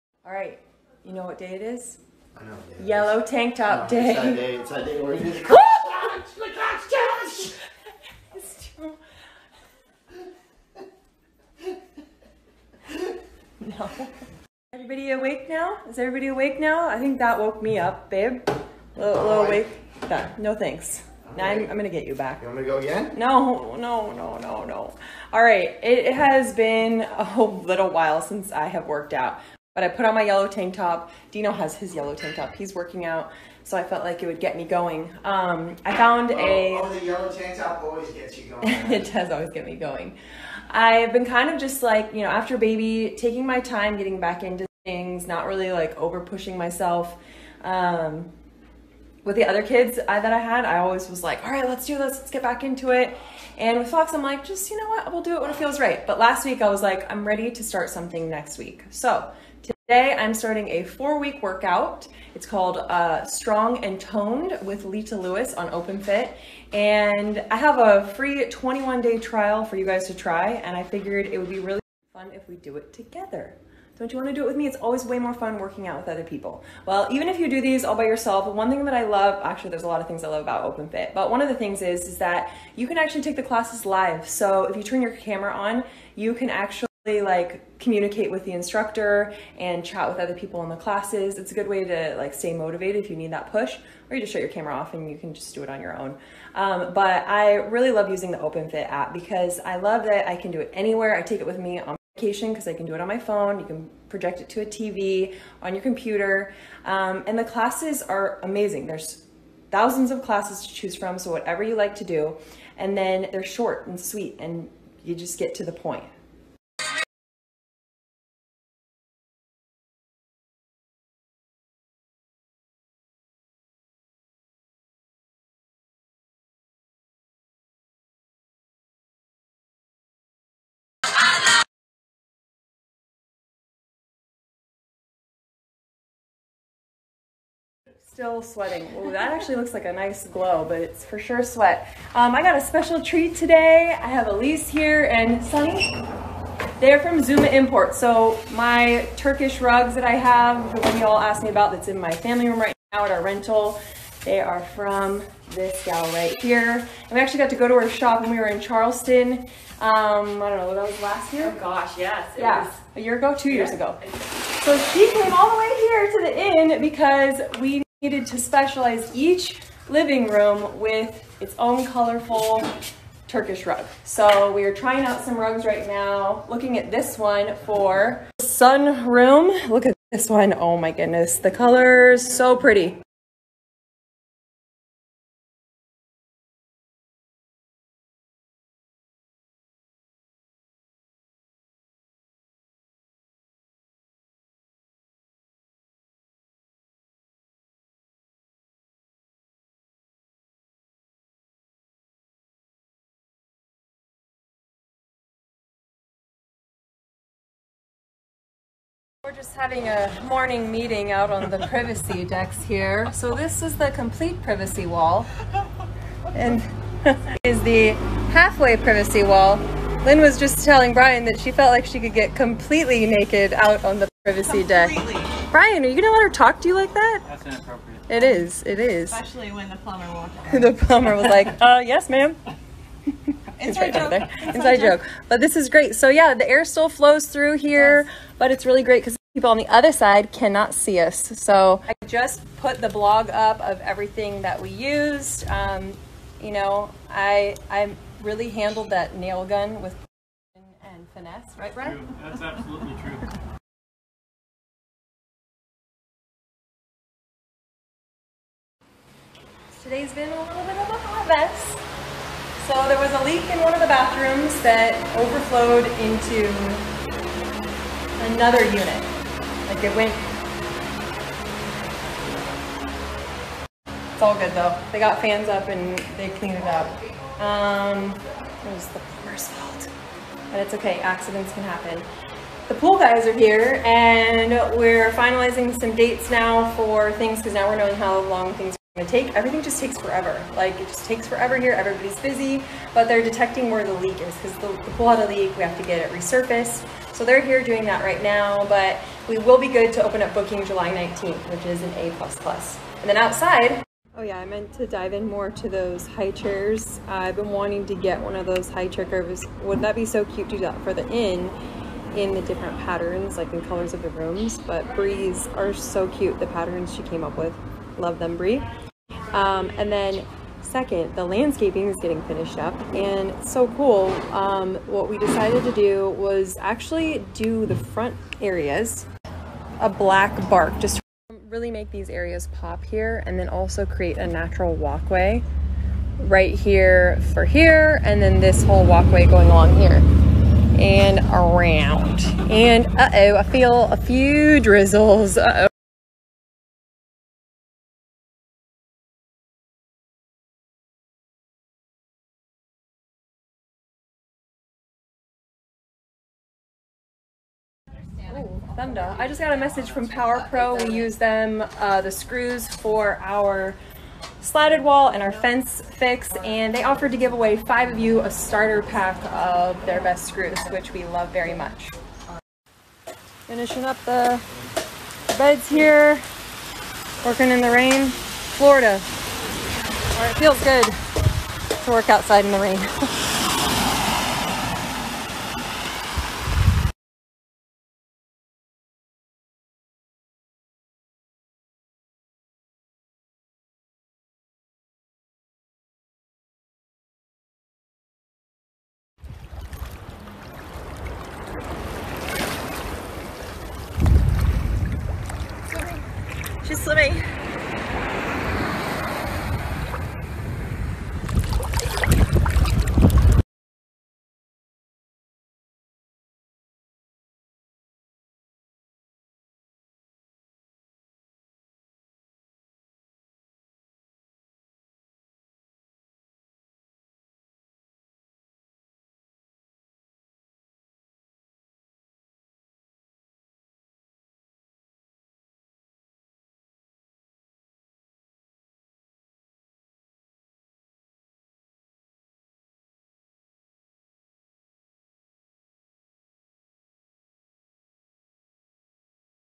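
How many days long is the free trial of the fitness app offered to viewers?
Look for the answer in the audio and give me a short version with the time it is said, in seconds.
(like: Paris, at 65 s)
21, at 68 s.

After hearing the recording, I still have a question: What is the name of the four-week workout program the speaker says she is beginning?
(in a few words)
Strong and Toned.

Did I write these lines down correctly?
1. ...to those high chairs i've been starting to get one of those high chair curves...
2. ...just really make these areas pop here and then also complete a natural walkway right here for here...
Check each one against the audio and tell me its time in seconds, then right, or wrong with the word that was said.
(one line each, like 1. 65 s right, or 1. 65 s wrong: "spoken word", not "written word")
1. 305 s wrong: "wanting", not "starting"
2. 330 s wrong: "create", not "complete".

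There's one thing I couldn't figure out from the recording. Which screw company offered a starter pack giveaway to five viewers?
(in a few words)
Power Pro.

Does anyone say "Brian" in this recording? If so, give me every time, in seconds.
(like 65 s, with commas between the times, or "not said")
220 s, 225 s.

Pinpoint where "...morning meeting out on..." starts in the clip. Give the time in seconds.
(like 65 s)
210 s.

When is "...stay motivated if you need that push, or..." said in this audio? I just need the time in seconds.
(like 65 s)
92 s.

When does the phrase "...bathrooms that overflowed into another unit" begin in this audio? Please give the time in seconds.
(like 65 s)
263 s.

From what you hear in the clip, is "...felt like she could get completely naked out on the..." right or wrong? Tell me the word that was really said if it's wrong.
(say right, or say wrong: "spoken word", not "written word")
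right.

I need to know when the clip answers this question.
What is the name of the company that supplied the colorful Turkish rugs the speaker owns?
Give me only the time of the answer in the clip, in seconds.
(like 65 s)
147 s.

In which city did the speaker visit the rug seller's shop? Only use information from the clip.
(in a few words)
Charleston.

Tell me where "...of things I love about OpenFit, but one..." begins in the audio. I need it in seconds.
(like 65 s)
80 s.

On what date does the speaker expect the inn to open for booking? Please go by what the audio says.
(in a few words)
July 19th.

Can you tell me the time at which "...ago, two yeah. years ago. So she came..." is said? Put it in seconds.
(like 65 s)
163 s.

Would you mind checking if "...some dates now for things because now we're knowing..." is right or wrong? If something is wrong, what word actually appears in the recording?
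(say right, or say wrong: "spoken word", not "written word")
right.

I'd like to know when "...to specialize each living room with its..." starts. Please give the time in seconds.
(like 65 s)
168 s.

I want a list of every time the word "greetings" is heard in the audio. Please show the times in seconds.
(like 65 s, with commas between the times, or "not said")
not said.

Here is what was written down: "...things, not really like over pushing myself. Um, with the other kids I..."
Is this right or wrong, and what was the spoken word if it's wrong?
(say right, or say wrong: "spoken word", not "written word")
right.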